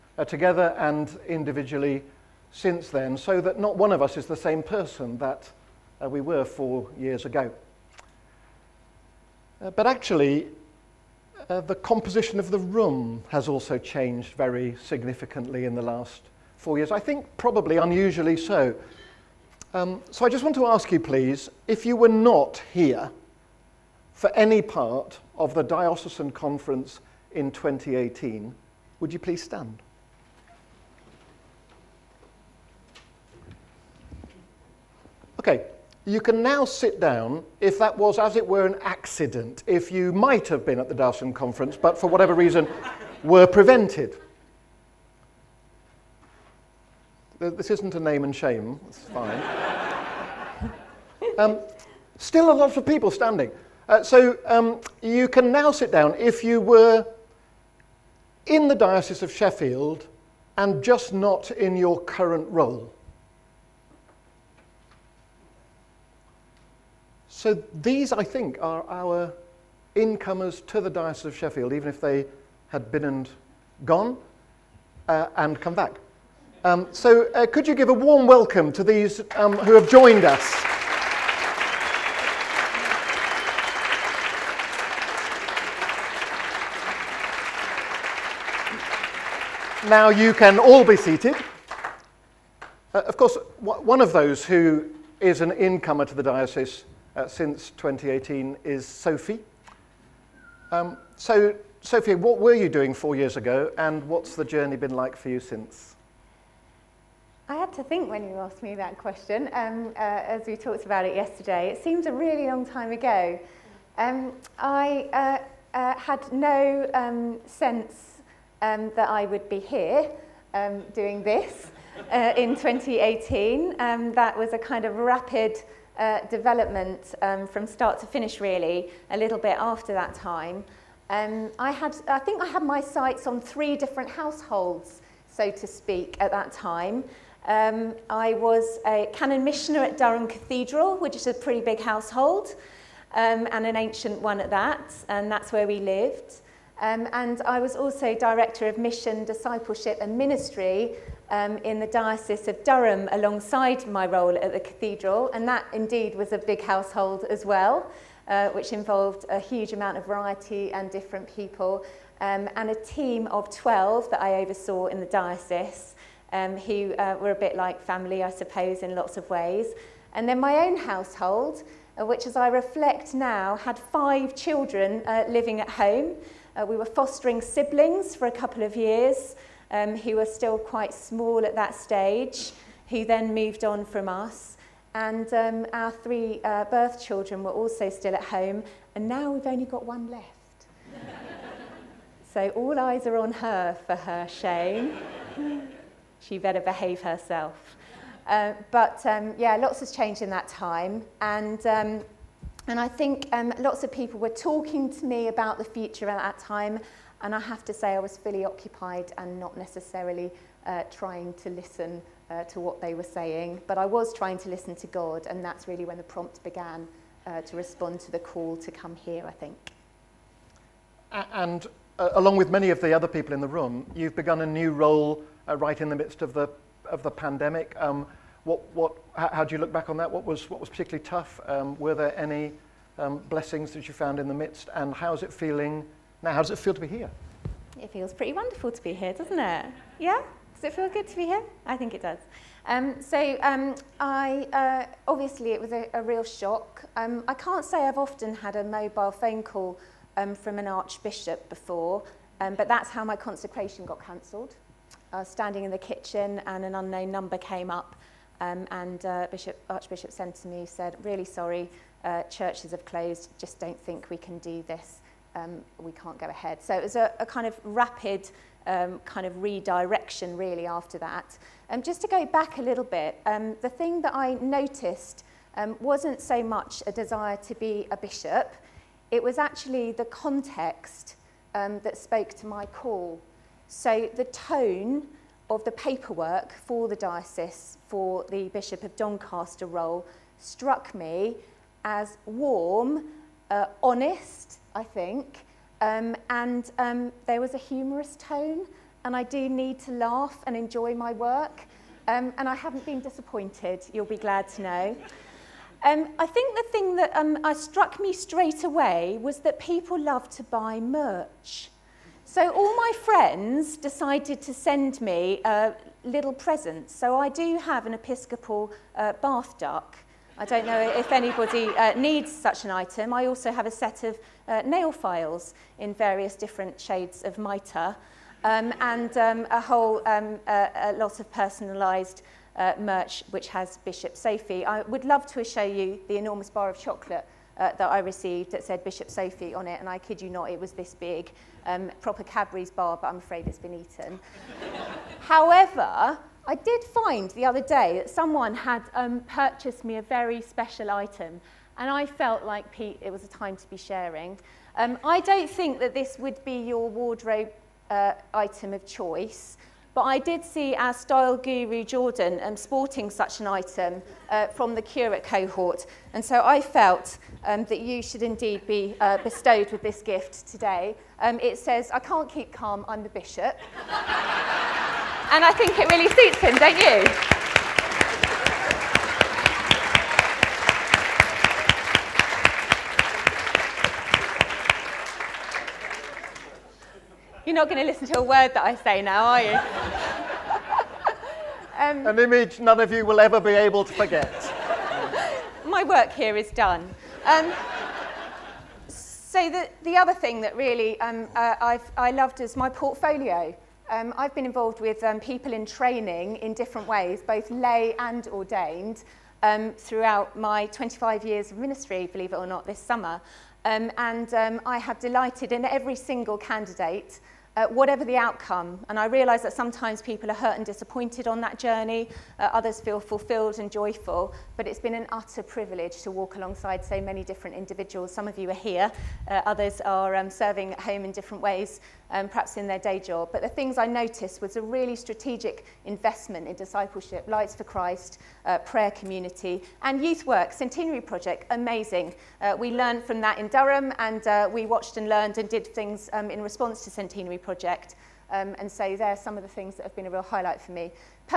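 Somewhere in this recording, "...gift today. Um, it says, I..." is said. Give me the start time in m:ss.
6:10.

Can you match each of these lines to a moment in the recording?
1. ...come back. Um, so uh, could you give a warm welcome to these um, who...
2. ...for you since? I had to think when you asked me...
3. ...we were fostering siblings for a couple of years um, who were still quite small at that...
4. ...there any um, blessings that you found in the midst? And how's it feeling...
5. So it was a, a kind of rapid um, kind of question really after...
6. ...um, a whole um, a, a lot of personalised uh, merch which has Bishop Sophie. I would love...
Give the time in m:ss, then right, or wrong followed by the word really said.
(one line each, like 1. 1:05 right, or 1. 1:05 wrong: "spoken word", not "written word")
1. 1:15 right
2. 1:45 right
3. 2:56 right
4. 3:51 right
5. 4:26 wrong: "redirection", not "question"
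6. 5:29 right.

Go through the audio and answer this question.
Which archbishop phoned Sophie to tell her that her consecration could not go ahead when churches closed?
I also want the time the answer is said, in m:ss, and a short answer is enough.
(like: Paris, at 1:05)
Archbishop Sentamu, at 4:19.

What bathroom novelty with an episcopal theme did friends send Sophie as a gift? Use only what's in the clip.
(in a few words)
Bath duck.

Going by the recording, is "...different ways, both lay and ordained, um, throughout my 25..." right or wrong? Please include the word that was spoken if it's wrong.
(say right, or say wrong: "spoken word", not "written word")
right.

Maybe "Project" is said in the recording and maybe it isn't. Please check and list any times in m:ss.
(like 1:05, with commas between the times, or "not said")
7:21, 7:27.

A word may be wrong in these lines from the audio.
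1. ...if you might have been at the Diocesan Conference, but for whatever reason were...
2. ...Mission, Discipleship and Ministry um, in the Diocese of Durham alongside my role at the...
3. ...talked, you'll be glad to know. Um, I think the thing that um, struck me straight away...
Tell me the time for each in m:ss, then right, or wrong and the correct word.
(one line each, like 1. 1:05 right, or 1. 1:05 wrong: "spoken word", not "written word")
1. 0:39 right
2. 2:28 right
3. 5:03 wrong: "disappointed", not "talked".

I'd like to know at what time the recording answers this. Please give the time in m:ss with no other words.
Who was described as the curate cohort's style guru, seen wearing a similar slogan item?
6:01.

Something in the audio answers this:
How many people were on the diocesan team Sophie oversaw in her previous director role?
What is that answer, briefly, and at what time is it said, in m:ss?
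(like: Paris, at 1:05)
12, at 2:43.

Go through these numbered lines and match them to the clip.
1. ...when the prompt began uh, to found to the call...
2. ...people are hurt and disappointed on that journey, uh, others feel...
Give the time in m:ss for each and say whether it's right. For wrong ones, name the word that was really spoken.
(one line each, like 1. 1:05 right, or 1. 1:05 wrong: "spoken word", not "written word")
1. 3:35 wrong: "respond", not "found"
2. 7:00 right.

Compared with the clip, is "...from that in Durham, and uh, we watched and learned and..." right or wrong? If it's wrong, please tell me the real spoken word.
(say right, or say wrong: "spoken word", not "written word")
right.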